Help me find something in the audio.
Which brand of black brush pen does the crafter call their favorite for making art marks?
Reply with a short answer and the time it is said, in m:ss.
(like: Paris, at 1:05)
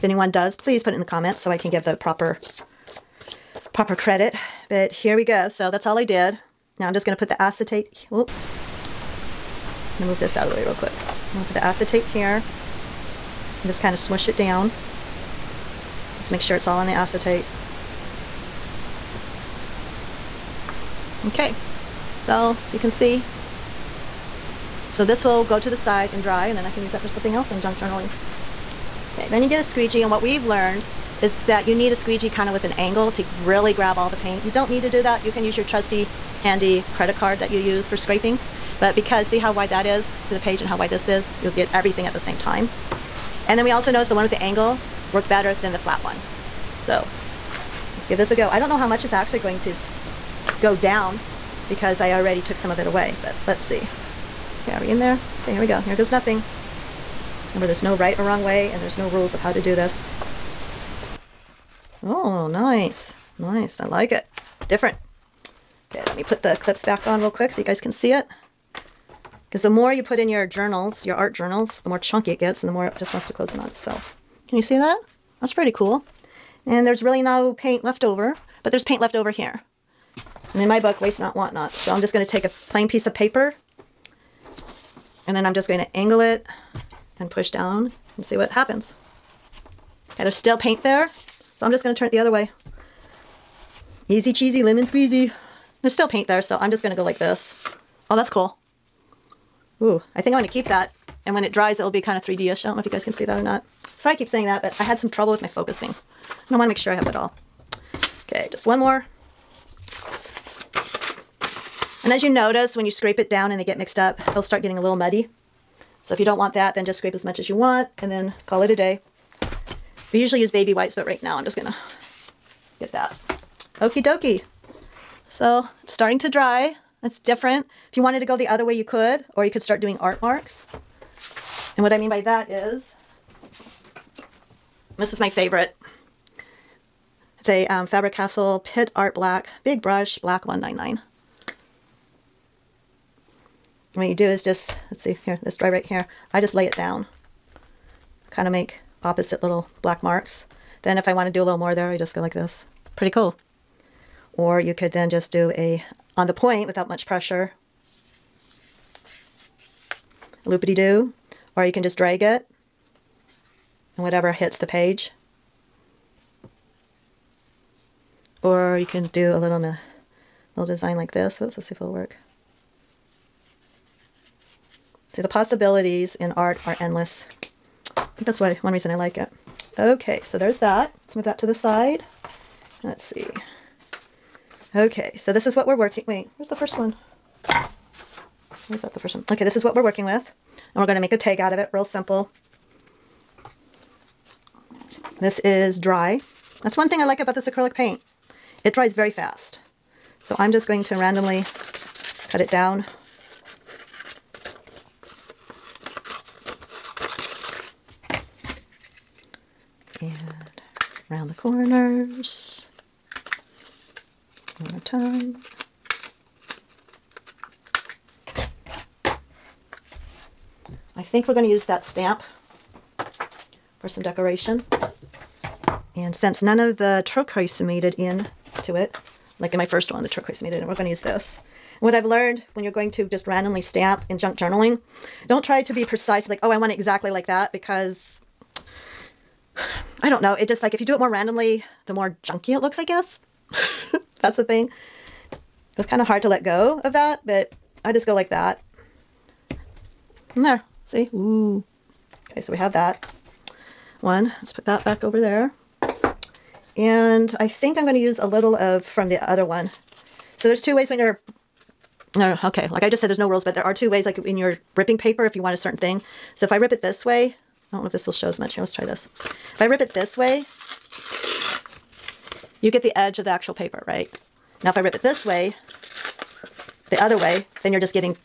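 Faber-Castell, at 2:17.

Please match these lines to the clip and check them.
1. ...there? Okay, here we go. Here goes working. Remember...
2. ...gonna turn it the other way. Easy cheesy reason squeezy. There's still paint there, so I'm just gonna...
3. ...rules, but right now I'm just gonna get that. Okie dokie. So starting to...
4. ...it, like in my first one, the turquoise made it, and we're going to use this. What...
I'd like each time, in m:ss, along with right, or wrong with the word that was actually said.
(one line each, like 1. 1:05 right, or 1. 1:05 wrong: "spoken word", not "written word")
1. 0:54 wrong: "nothing", not "working"
2. 1:31 wrong: "lemon", not "reason"
3. 2:00 wrong: "wipes", not "rules"
4. 3:48 right.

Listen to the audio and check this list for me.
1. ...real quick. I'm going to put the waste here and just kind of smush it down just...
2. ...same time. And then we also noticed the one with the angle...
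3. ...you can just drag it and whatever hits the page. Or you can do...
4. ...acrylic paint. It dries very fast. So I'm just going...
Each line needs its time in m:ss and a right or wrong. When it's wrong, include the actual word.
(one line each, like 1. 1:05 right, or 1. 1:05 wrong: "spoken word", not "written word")
1. 0:10 wrong: "acetate", not "waste"
2. 0:42 right
3. 2:41 right
4. 3:17 right.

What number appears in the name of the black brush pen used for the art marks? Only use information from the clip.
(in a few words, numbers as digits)
199.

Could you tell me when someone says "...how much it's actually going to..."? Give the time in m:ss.
0:48.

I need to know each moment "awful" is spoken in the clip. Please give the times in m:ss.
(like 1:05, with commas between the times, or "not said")
not said.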